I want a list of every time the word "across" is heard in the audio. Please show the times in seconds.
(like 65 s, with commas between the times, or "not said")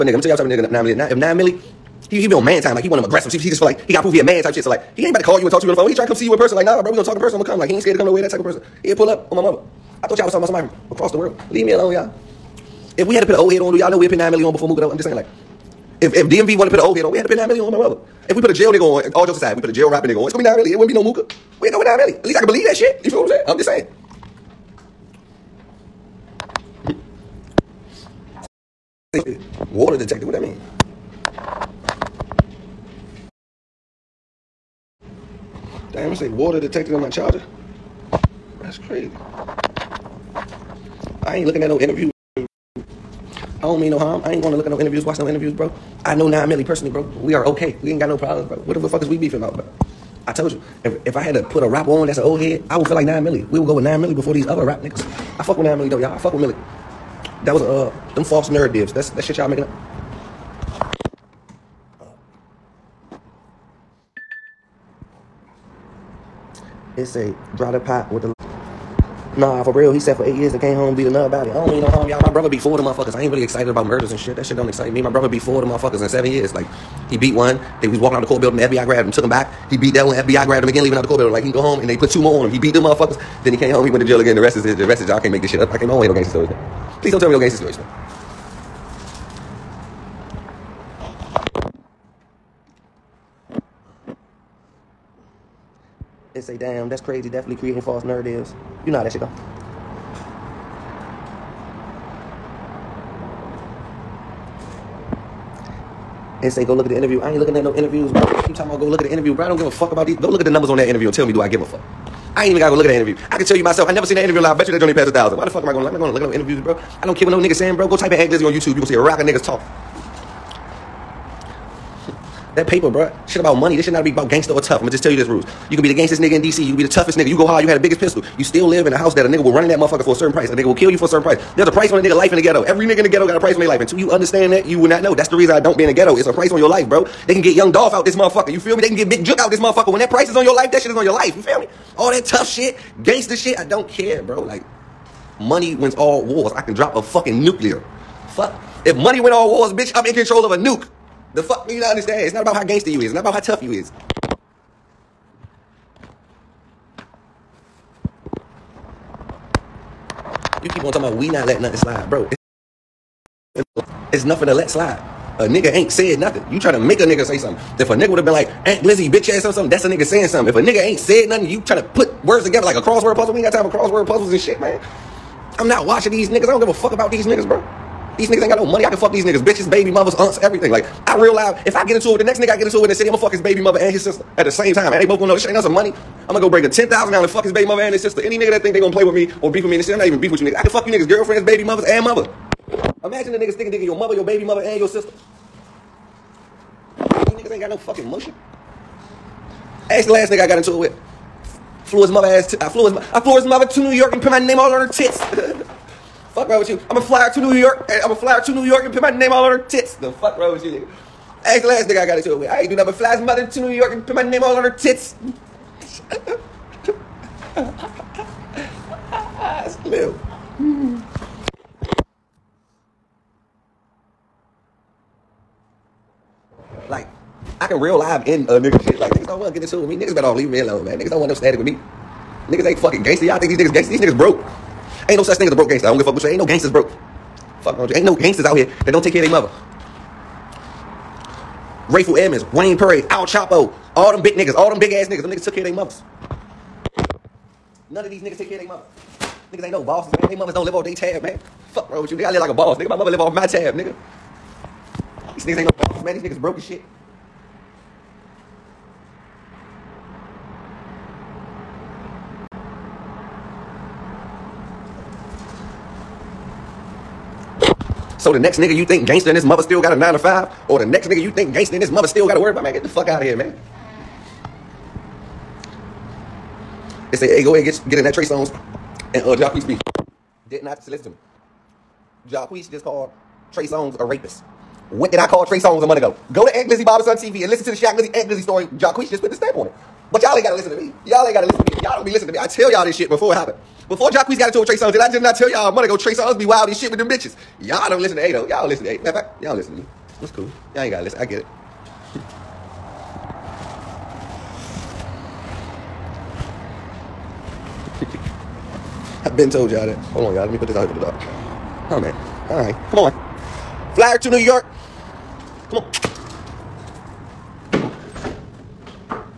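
10 s.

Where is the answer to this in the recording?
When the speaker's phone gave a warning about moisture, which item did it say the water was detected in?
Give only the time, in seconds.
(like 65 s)
37 s.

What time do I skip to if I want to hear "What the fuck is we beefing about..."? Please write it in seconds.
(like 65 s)
48 s.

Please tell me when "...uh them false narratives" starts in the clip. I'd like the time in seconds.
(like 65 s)
57 s.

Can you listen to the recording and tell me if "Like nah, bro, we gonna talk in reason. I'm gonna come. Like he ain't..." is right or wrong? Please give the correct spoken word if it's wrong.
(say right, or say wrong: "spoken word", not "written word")
wrong: "person", not "reason".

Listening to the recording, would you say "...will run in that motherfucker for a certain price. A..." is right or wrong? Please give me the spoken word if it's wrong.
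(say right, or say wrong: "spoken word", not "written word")
right.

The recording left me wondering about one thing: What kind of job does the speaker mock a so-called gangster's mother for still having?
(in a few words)
9 to 5.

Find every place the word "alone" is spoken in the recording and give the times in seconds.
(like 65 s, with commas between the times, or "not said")
11 s, 230 s.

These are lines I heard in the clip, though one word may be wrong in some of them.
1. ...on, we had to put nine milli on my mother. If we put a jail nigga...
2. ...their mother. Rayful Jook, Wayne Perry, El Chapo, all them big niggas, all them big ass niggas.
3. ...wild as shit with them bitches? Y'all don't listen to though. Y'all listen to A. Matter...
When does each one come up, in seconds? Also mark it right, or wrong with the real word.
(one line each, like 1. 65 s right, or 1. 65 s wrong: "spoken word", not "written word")
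1. 17 s right
2. 239 s wrong: "Edmonds", not "Jook"
3. 296 s right.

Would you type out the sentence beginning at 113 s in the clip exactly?
I can tell you myself, I never seen that interview live.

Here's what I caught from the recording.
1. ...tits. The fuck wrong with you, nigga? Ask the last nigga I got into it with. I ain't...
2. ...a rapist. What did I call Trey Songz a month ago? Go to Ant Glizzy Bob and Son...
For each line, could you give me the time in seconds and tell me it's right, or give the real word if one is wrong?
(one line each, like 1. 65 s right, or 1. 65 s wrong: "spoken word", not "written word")
1. 209 s right
2. 283 s right.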